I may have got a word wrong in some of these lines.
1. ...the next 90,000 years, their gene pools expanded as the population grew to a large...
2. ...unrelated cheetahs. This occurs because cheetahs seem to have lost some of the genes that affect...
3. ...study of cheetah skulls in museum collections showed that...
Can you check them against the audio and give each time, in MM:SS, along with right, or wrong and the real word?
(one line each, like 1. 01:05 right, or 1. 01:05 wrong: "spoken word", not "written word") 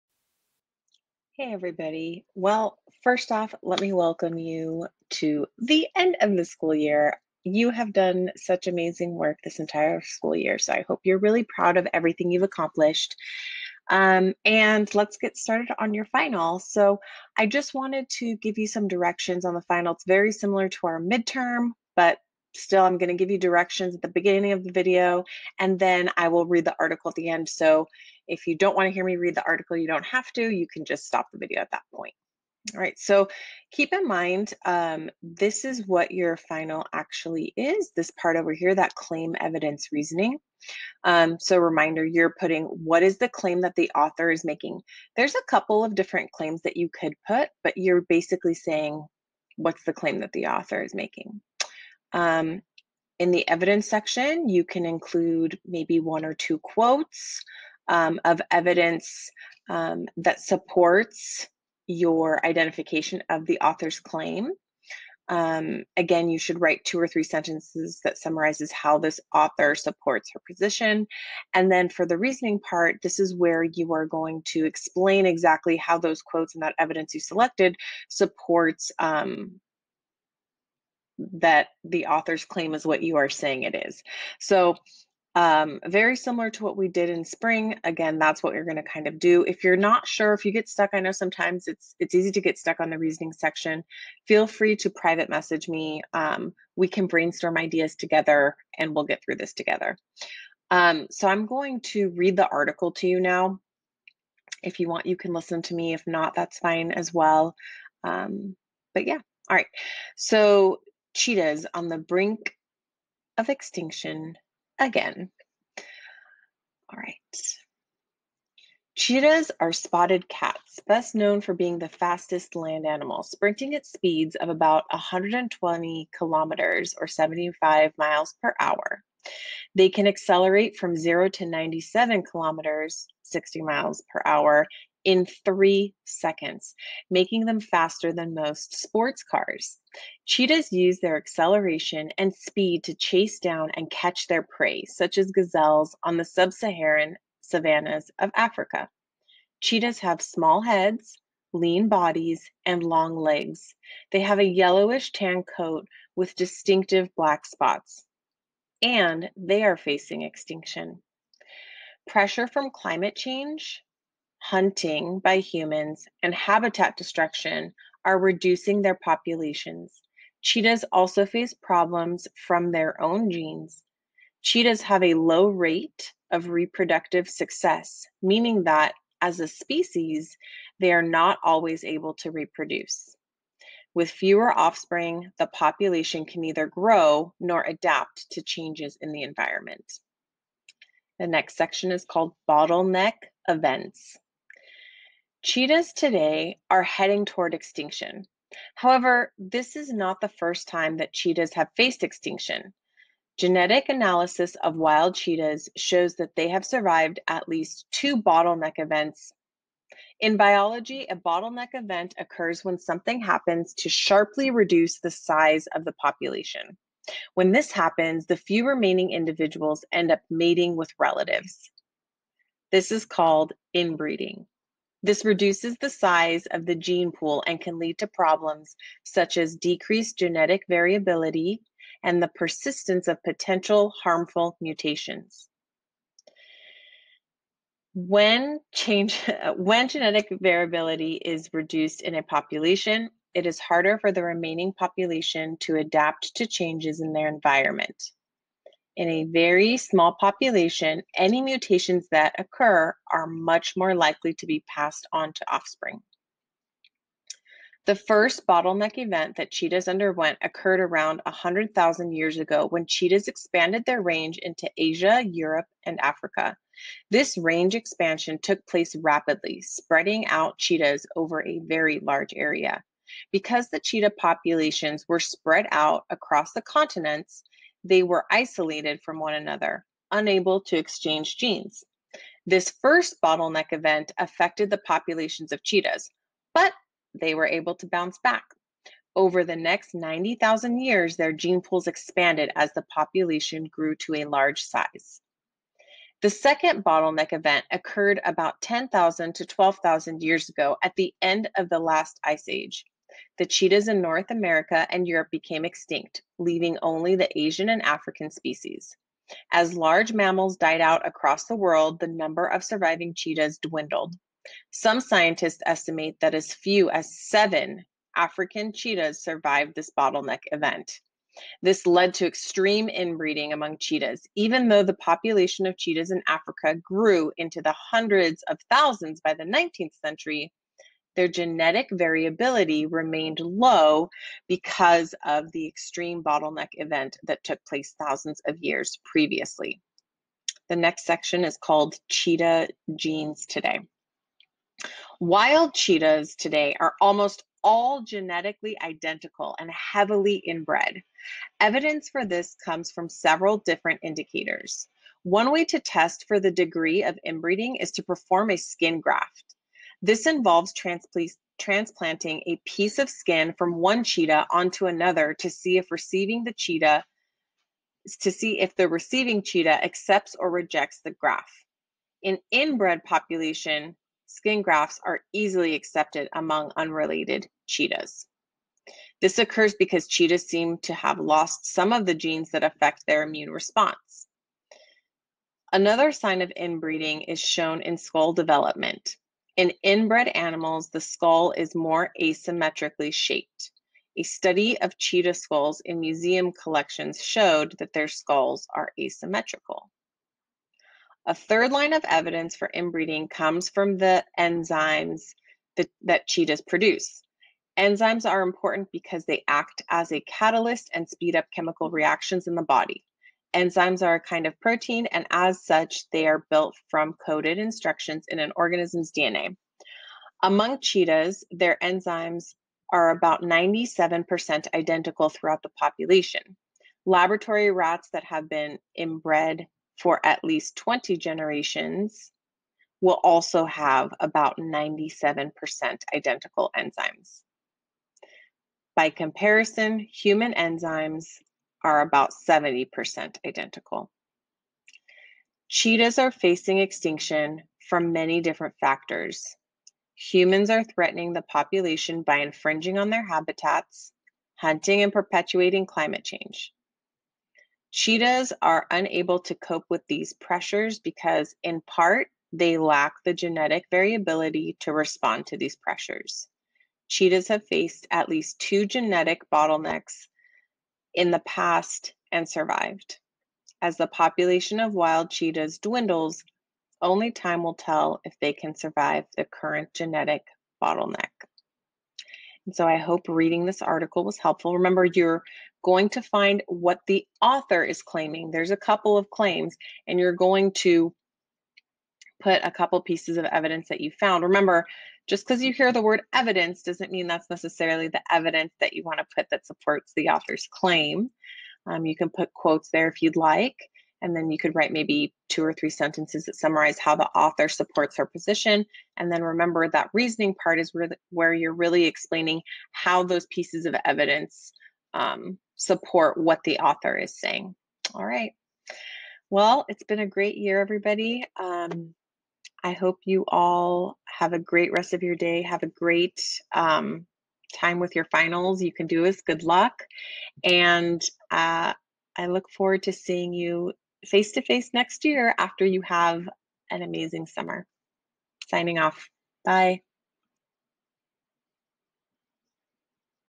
1. 04:49 right
2. 06:16 right
3. 06:34 right.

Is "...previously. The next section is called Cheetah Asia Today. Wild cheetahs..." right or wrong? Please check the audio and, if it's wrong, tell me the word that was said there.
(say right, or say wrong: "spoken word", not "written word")
wrong: "Genes", not "Asia".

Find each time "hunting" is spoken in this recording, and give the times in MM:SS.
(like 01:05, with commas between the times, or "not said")
02:44, 07:34.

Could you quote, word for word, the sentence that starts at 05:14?
Some scientists estimate that as few as seven African cheetahs survived this bottleneck event.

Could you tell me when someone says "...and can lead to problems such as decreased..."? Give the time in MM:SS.
03:47.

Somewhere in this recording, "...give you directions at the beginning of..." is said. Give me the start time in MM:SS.
00:23.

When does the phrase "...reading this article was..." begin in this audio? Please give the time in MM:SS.
08:03.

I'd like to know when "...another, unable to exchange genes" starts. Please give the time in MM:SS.
04:39.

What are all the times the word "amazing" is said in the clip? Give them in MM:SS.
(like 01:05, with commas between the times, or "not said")
00:08, 08:57.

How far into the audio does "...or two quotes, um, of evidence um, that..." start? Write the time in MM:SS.
00:56.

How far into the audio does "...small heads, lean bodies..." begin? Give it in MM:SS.
02:30.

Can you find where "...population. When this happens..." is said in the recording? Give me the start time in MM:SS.
03:35.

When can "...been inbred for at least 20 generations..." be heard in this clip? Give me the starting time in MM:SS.
07:08.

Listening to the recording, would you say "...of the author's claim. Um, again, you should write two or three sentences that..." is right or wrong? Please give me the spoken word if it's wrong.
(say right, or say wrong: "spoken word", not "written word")
right.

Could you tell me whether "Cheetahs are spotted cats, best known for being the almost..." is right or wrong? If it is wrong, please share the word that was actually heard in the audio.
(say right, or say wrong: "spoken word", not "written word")
wrong: "fastest", not "almost".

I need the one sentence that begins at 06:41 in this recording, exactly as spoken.
A third line of evidence for inbreeding comes from the enzymes that, that cheetahs produce.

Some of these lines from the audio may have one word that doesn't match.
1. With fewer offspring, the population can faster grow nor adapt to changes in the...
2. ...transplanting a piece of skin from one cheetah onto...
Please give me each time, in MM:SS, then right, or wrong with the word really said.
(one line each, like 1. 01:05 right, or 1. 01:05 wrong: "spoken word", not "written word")
1. 03:03 wrong: "neither", not "faster"
2. 06:01 right.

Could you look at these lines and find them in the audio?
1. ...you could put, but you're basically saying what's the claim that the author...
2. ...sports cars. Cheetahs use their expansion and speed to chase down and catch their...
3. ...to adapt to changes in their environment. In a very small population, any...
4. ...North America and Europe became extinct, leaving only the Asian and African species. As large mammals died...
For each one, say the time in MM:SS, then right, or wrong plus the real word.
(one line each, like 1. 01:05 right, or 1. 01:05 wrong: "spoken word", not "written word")
1. 00:46 right
2. 02:18 wrong: "acceleration", not "expansion"
3. 04:05 right
4. 05:04 right.